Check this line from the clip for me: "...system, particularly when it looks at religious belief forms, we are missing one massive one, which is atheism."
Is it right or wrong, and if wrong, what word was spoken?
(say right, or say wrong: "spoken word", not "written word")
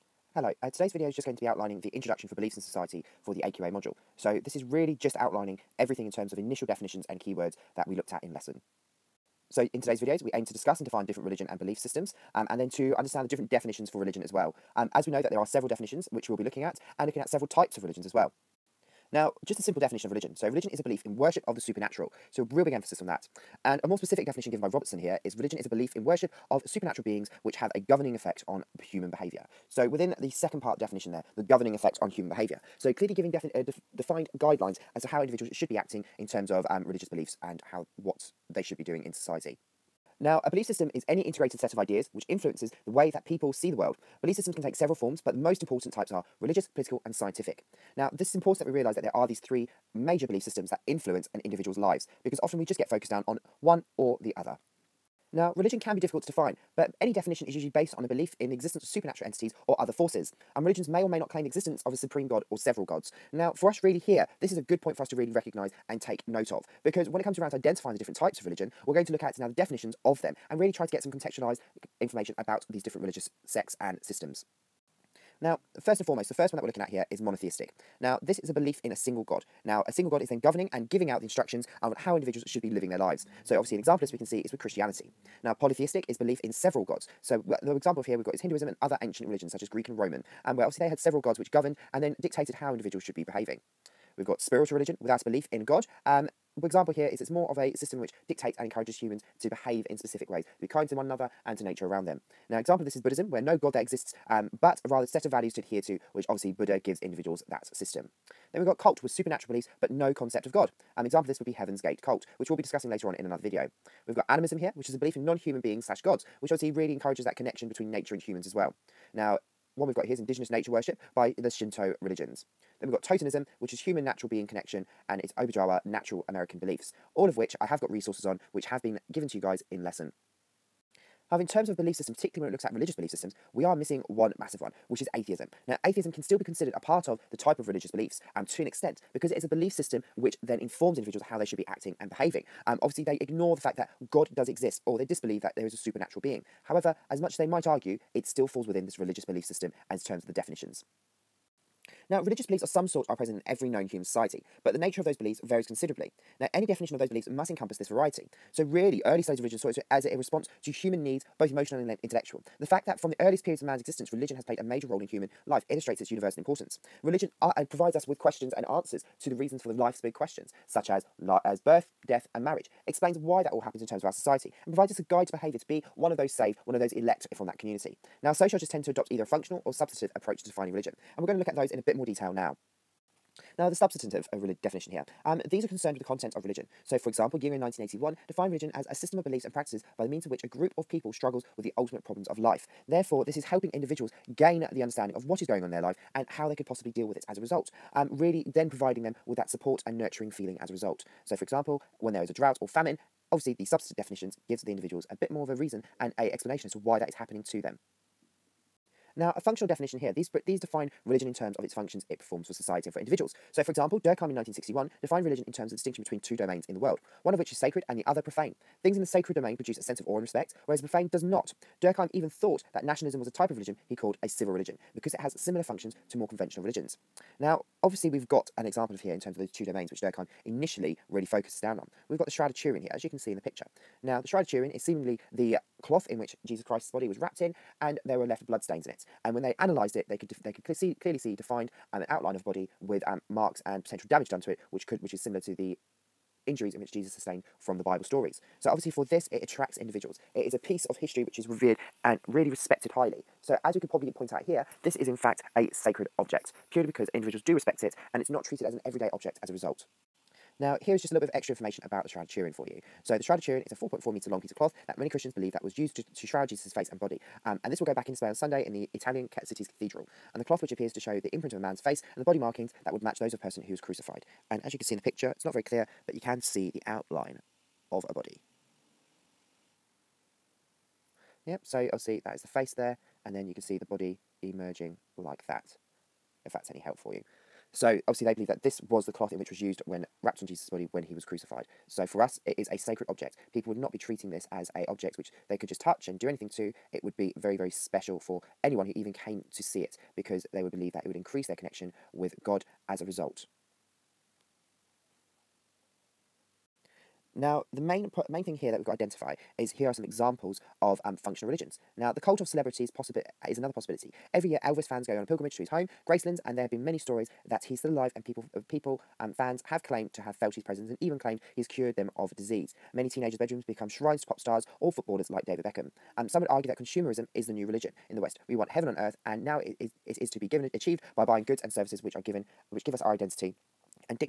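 wrong: "systems", not "forms".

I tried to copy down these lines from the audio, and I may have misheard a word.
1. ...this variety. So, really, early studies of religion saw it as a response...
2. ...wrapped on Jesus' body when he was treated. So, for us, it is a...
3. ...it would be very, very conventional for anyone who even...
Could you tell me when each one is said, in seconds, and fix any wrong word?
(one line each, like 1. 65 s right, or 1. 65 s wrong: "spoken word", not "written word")
1. 157 s right
2. 290 s wrong: "crucified", not "treated"
3. 296 s wrong: "special", not "conventional".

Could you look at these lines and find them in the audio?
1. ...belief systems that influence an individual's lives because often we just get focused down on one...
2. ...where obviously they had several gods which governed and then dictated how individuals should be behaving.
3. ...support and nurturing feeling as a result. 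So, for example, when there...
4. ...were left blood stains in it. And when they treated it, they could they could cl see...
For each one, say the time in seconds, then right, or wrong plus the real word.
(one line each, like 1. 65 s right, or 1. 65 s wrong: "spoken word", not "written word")
1. 50 s right
2. 90 s right
3. 199 s right
4. 238 s wrong: "analysed", not "treated".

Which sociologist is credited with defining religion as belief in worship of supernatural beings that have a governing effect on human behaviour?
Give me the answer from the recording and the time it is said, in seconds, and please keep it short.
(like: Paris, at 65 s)
Robertson, at 24 s.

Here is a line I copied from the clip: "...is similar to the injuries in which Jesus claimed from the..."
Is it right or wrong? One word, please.
wrong.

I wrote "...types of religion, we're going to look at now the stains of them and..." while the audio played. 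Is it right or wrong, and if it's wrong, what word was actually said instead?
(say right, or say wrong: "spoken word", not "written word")
wrong: "definitions", not "stains".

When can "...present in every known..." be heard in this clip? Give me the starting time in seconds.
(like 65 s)
153 s.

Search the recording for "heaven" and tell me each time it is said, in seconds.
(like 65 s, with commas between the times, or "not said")
111 s, 328 s.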